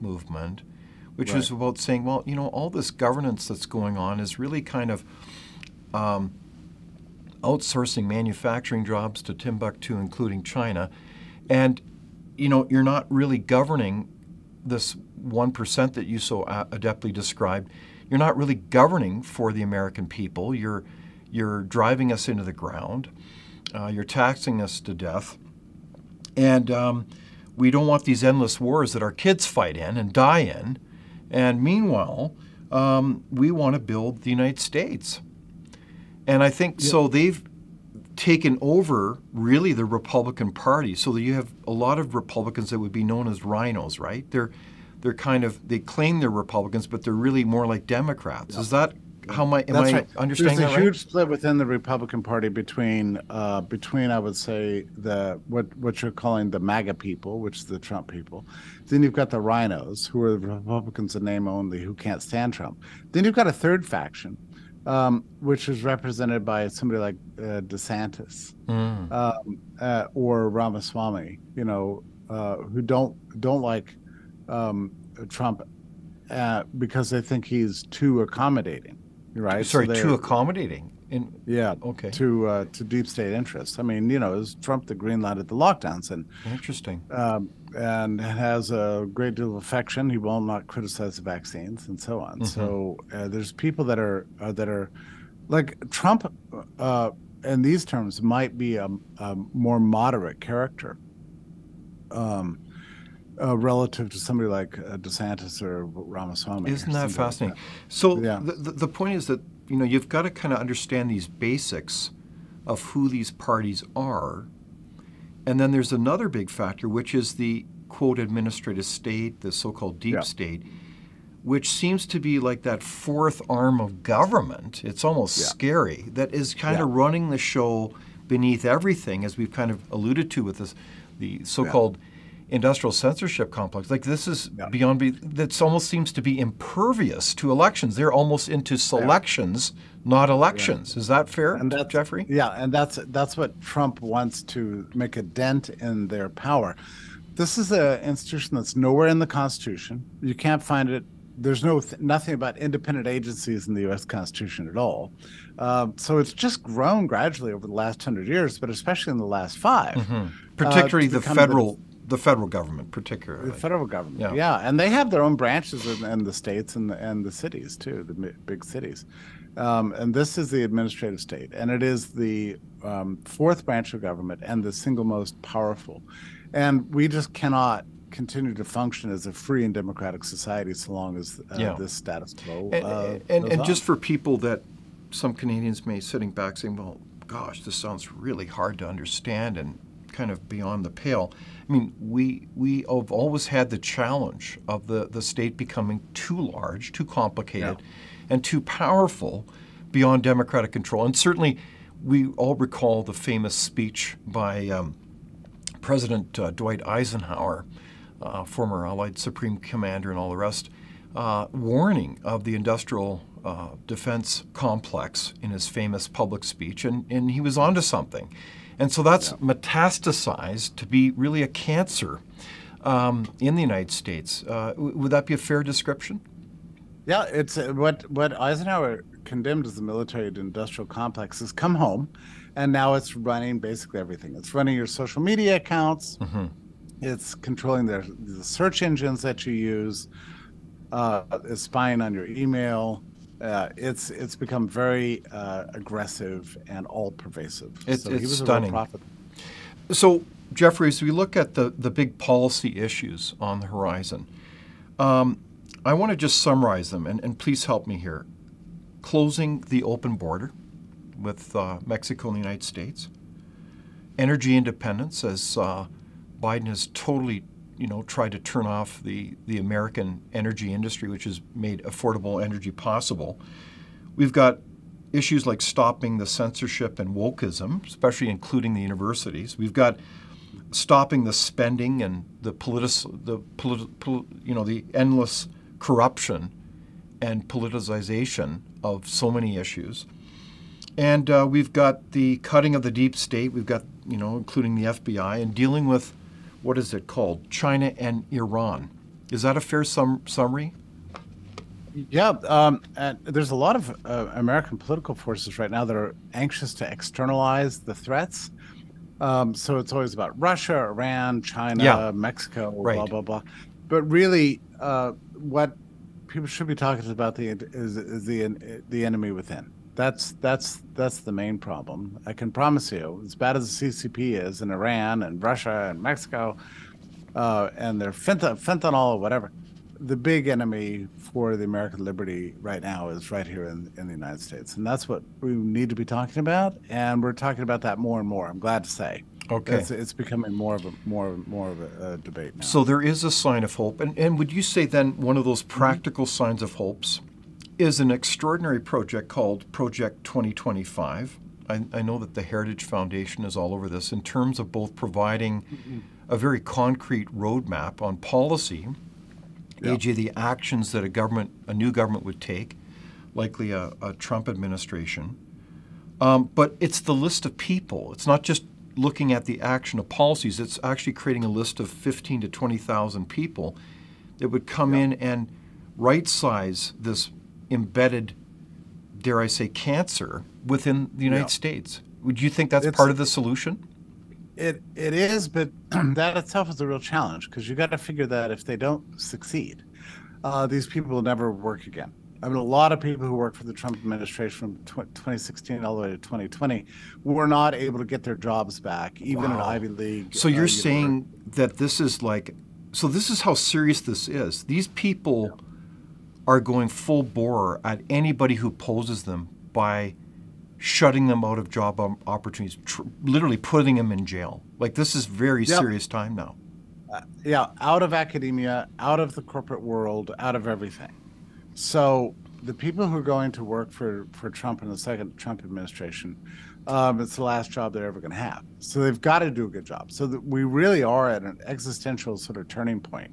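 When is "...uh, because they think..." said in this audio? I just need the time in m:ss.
1:16.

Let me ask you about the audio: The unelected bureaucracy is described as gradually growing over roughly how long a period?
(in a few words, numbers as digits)
Last hundred years.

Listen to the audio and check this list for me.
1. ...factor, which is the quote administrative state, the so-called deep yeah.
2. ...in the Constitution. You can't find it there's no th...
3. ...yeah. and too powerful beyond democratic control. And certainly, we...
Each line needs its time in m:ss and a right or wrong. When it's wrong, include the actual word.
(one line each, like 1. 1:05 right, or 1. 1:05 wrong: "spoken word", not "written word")
1. 1:56 right
2. 2:29 right
3. 3:17 right.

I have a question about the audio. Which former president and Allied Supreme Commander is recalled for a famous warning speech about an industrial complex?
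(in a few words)
Dwight Eisenhower.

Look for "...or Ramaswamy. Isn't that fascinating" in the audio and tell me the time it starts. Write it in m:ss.
1:45.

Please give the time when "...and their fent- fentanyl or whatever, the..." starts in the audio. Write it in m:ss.
5:27.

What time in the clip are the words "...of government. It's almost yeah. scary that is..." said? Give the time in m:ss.
2:03.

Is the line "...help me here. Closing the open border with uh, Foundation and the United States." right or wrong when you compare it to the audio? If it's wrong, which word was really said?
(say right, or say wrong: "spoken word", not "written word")
wrong: "Mexico", not "Foundation".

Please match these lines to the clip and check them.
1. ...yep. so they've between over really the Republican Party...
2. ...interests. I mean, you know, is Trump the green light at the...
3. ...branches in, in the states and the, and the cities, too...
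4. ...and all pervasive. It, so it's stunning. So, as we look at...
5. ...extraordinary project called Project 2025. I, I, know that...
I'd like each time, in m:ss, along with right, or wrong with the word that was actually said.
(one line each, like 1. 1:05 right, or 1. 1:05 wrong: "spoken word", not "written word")
1. 0:36 wrong: "taken", not "between"
2. 1:23 right
3. 2:45 right
4. 4:06 right
5. 5:48 right.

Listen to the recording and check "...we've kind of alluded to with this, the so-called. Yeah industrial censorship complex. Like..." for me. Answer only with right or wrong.
right.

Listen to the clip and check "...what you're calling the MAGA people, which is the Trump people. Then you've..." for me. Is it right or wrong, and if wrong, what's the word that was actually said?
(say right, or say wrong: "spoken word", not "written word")
right.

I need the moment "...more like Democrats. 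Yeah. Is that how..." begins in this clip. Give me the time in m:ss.
0:47.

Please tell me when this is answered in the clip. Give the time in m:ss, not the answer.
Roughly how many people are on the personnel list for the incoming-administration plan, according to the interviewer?
6:11.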